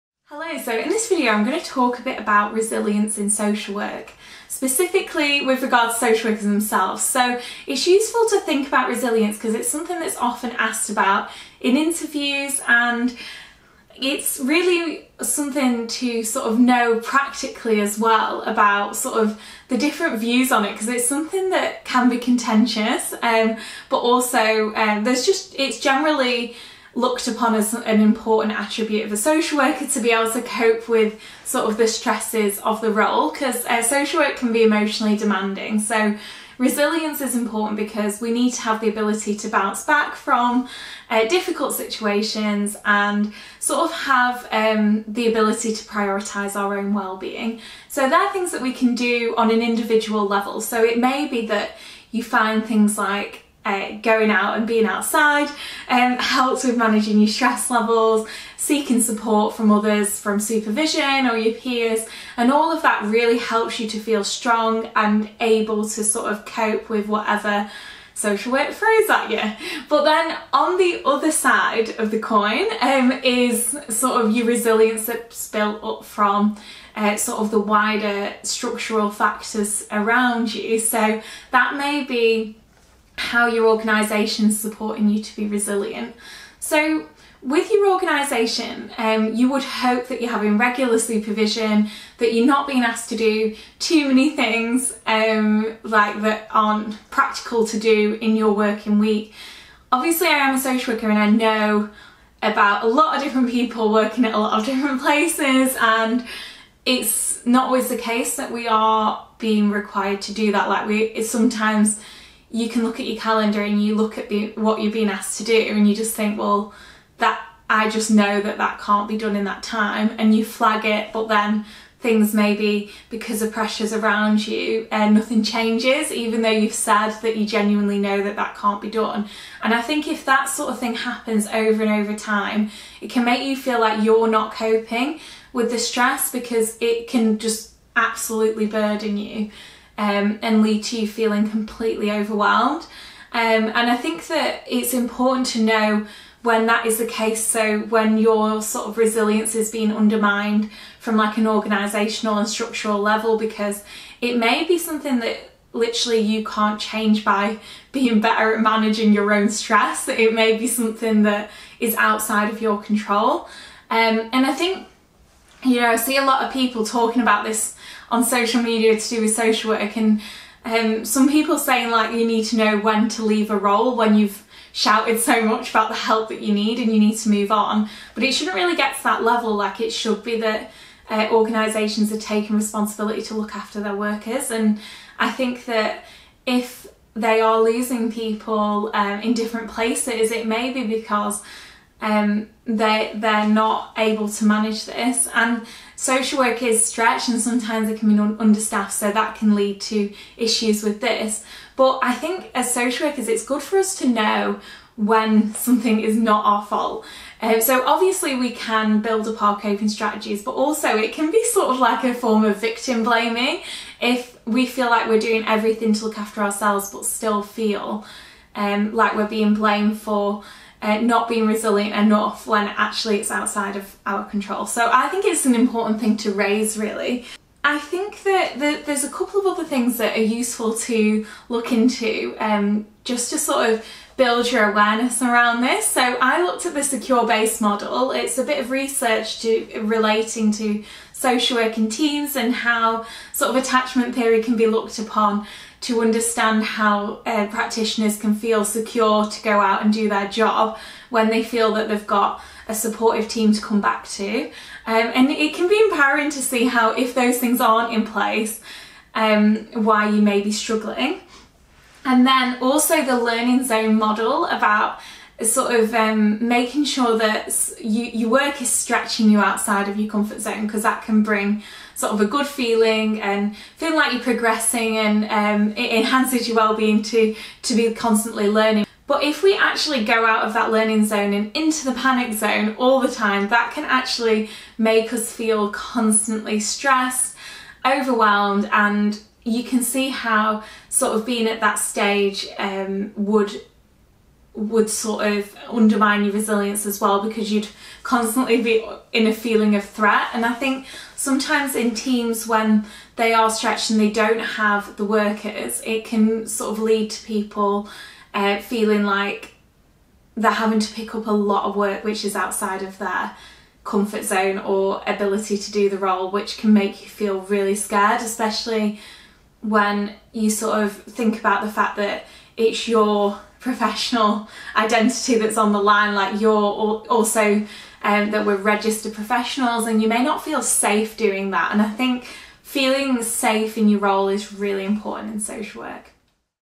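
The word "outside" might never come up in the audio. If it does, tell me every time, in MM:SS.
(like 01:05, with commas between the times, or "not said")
00:54, 02:41, 03:43, 04:29, 05:12.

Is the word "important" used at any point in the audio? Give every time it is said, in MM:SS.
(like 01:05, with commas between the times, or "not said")
00:28, 00:37, 02:24, 03:45, 05:34.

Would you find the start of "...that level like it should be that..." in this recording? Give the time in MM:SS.
02:59.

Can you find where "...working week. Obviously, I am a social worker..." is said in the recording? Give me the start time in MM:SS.
01:38.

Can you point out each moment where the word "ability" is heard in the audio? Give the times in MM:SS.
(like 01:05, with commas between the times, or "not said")
00:38, 00:45, 05:15.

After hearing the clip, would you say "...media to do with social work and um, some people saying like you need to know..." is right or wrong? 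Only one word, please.
right.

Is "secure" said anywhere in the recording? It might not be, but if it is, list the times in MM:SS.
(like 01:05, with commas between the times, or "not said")
03:56, 04:08.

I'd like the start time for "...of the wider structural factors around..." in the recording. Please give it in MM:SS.
01:17.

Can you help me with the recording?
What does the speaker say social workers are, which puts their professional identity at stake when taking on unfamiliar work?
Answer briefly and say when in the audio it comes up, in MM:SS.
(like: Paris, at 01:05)
registered professionals, at 05:28.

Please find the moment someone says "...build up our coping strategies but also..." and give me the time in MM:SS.
03:29.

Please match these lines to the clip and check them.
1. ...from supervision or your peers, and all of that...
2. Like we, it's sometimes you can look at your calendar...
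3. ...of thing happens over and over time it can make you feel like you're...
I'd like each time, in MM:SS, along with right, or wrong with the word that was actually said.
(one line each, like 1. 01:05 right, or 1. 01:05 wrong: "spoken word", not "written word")
1. 01:00 right
2. 01:50 right
3. 02:10 right.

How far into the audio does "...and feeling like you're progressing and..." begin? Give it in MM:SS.
04:33.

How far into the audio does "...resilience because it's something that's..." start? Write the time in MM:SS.
00:08.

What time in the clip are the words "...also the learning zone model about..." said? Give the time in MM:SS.
04:22.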